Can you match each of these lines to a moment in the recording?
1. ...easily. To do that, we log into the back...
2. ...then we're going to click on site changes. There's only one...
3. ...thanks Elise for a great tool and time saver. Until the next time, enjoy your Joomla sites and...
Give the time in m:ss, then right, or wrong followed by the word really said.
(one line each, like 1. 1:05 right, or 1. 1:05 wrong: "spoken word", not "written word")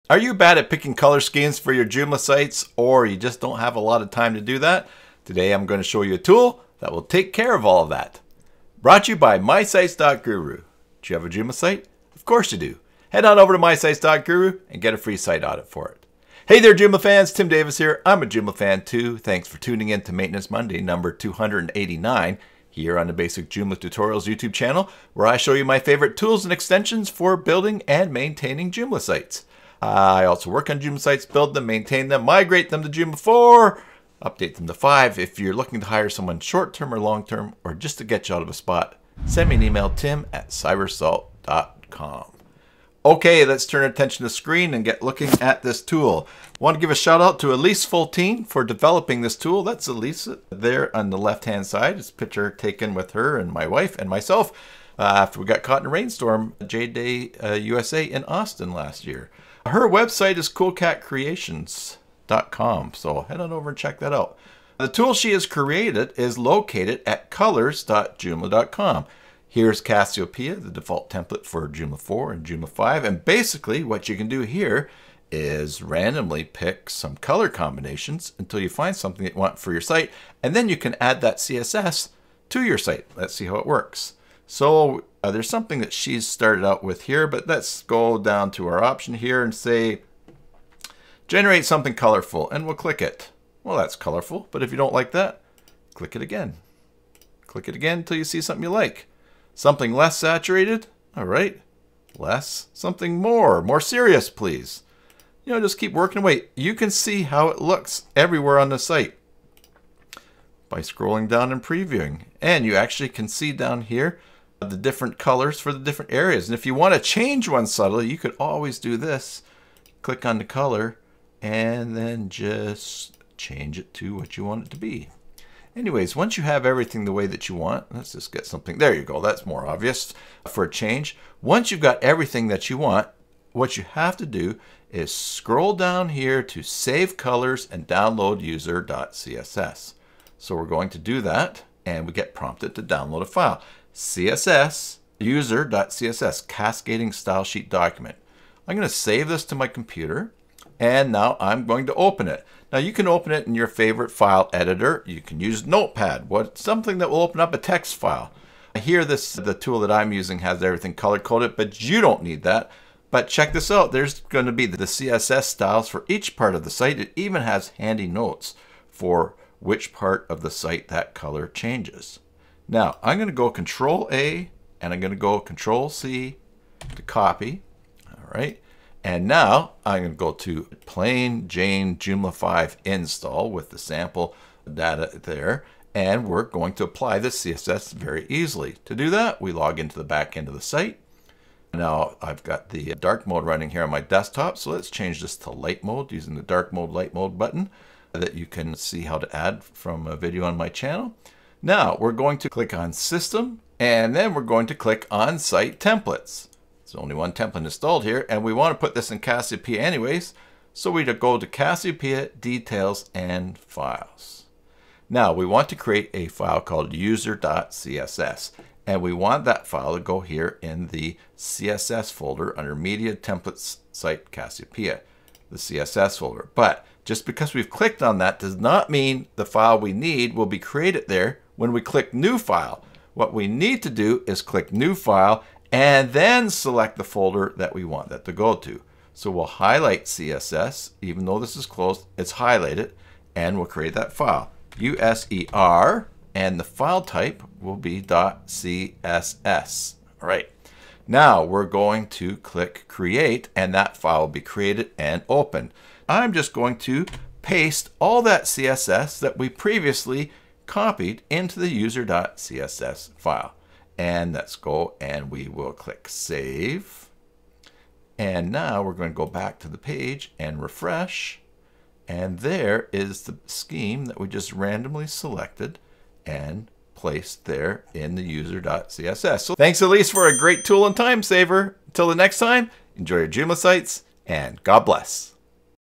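1. 3:08 right
2. 3:24 wrong: "templates", not "changes"
3. 4:39 right.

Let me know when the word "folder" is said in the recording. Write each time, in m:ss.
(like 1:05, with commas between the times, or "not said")
3:42, 3:46, 3:57.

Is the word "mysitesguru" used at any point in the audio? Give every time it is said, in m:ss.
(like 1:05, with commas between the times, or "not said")
0:09, 0:13.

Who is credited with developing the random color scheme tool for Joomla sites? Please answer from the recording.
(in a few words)
Elise Foltyn.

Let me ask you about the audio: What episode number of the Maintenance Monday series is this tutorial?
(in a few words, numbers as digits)
289.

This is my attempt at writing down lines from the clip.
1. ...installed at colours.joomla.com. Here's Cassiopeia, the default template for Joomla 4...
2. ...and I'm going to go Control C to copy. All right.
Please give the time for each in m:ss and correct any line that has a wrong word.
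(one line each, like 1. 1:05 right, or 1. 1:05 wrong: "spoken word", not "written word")
1. 1:06 wrong: "located", not "installed"
2. 2:54 right.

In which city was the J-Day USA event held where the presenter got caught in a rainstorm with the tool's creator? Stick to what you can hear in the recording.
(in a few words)
Austin.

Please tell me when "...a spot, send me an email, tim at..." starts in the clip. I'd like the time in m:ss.
0:38.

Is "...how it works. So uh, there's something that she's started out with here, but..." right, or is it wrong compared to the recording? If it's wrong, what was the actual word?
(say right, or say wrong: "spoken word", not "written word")
right.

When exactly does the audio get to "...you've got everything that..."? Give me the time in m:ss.
2:11.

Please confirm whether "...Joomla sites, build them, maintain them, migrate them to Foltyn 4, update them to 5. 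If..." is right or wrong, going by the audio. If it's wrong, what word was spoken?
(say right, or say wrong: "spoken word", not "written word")
wrong: "Joomla", not "Foltyn".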